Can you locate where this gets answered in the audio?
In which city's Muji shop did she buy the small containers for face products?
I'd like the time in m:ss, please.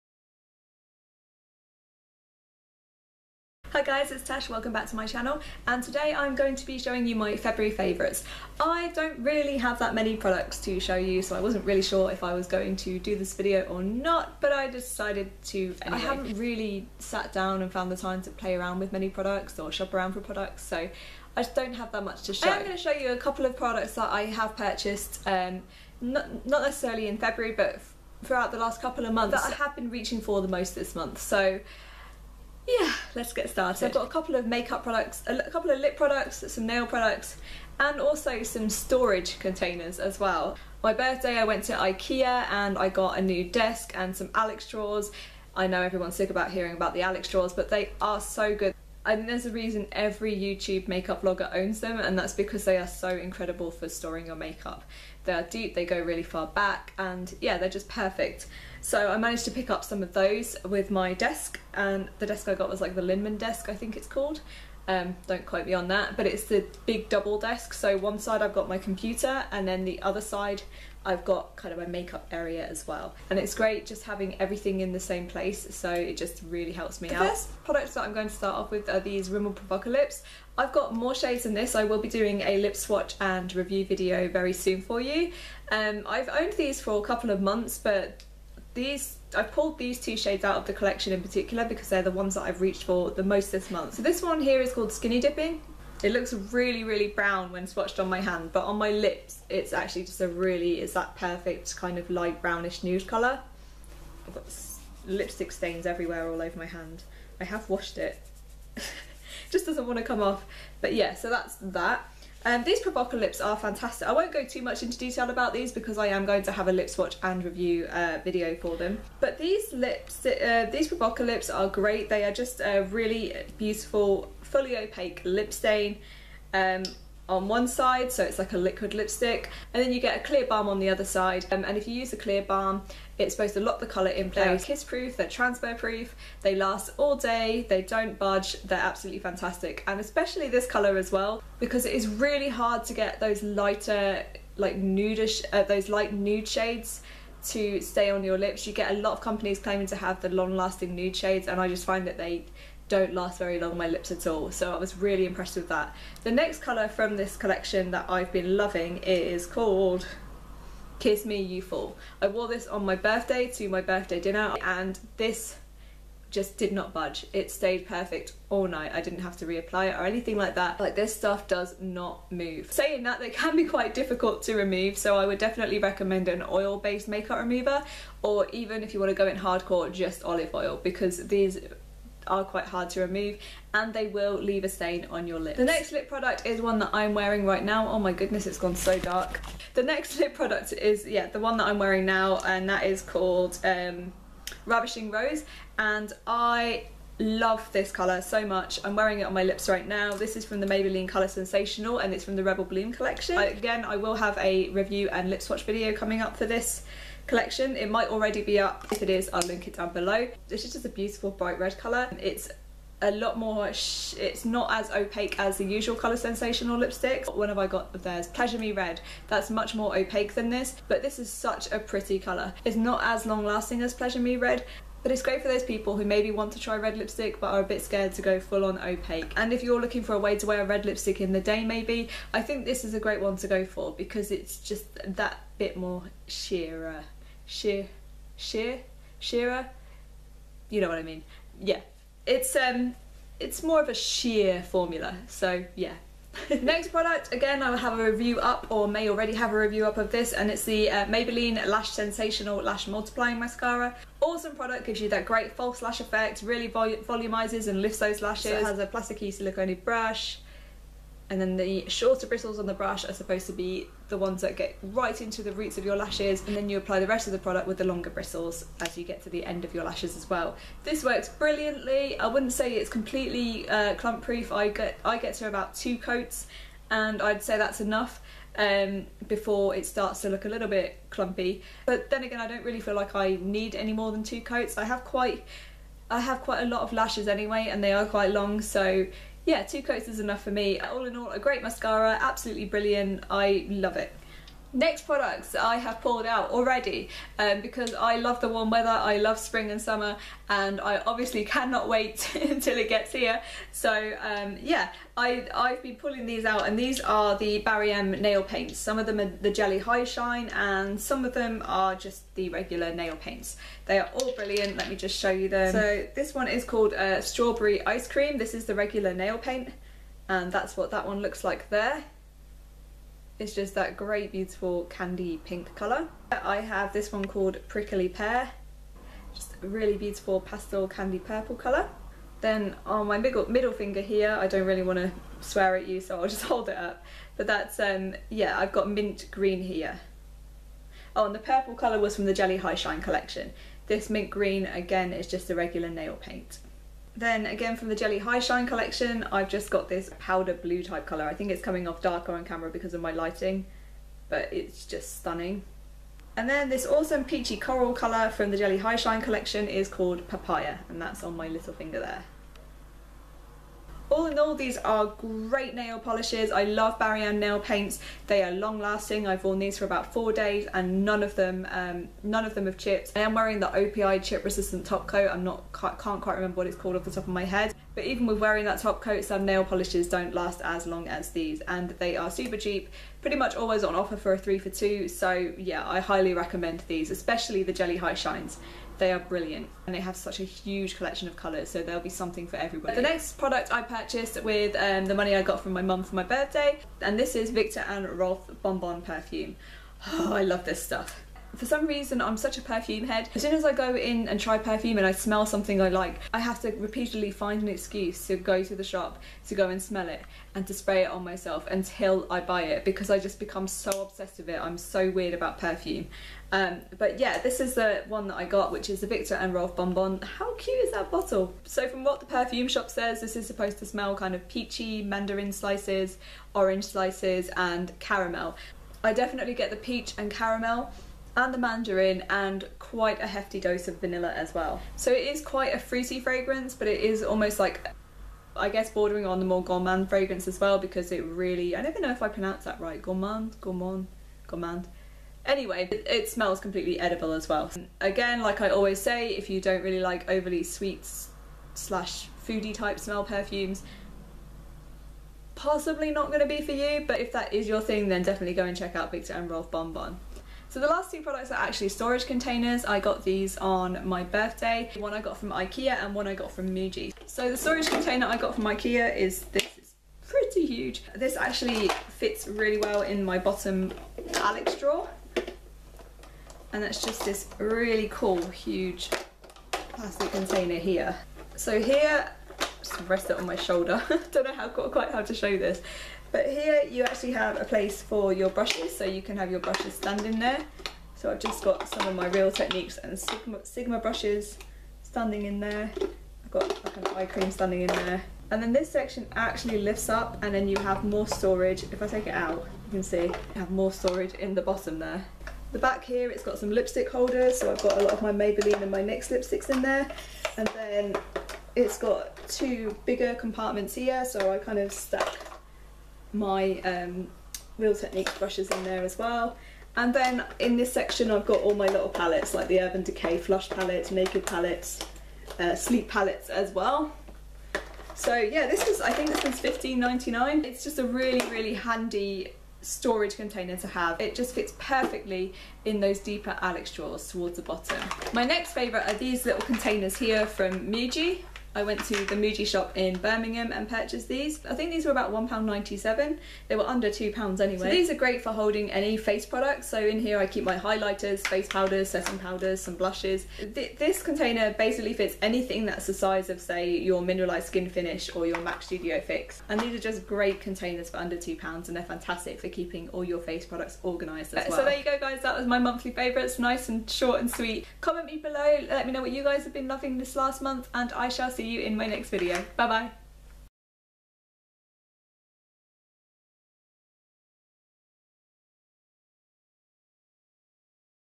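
9:03.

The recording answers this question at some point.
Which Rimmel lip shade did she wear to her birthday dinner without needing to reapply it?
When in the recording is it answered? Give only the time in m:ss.
2:40.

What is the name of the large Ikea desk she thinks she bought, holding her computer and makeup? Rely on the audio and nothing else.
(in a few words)
Linnmon.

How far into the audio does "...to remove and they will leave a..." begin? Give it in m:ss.
3:02.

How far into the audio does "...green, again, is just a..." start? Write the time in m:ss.
5:44.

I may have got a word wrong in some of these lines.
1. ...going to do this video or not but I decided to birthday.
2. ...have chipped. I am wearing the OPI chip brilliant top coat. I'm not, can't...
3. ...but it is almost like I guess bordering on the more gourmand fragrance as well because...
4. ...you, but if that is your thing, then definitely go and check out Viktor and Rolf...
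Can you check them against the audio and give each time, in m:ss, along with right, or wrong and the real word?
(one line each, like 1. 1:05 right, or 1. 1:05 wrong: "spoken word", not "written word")
1. 0:12 wrong: "anyway", not "birthday"
2. 6:12 wrong: "resistant", not "brilliant"
3. 7:16 right
4. 7:36 right.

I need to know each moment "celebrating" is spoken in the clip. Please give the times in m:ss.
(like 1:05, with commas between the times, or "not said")
not said.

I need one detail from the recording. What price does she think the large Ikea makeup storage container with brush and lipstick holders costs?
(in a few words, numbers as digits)
15.99.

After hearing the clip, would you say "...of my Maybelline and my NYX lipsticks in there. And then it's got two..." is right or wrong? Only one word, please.
right.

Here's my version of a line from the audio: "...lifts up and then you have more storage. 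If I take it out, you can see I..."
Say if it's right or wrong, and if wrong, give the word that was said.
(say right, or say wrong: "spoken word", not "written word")
right.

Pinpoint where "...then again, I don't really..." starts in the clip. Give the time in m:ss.
4:42.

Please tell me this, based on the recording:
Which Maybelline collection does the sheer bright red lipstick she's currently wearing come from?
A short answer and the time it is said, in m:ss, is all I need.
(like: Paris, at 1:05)
Rebel Bloom, at 3:22.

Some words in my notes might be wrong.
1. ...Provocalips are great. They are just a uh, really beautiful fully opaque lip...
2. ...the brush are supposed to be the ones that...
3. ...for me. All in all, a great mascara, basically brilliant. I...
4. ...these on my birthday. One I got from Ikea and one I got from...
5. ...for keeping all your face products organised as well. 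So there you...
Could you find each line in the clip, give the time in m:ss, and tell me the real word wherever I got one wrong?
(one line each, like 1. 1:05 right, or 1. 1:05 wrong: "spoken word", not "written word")
1. 2:00 right
2. 4:22 right
3. 4:50 wrong: "absolutely", not "basically"
4. 7:43 right
5. 9:22 right.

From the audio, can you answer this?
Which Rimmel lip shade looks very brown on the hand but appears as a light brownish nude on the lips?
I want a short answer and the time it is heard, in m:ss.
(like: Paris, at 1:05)
Skinny Dipping, at 1:34.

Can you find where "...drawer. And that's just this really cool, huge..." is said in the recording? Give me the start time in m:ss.
7:54.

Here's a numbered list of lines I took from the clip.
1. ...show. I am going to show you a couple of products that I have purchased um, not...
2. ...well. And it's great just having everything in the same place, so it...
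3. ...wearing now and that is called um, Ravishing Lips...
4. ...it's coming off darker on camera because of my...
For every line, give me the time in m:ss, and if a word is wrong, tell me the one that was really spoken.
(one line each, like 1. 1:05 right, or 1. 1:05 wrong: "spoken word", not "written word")
1. 0:22 right
2. 1:12 right
3. 3:11 wrong: "Rose", not "Lips"
4. 5:51 right.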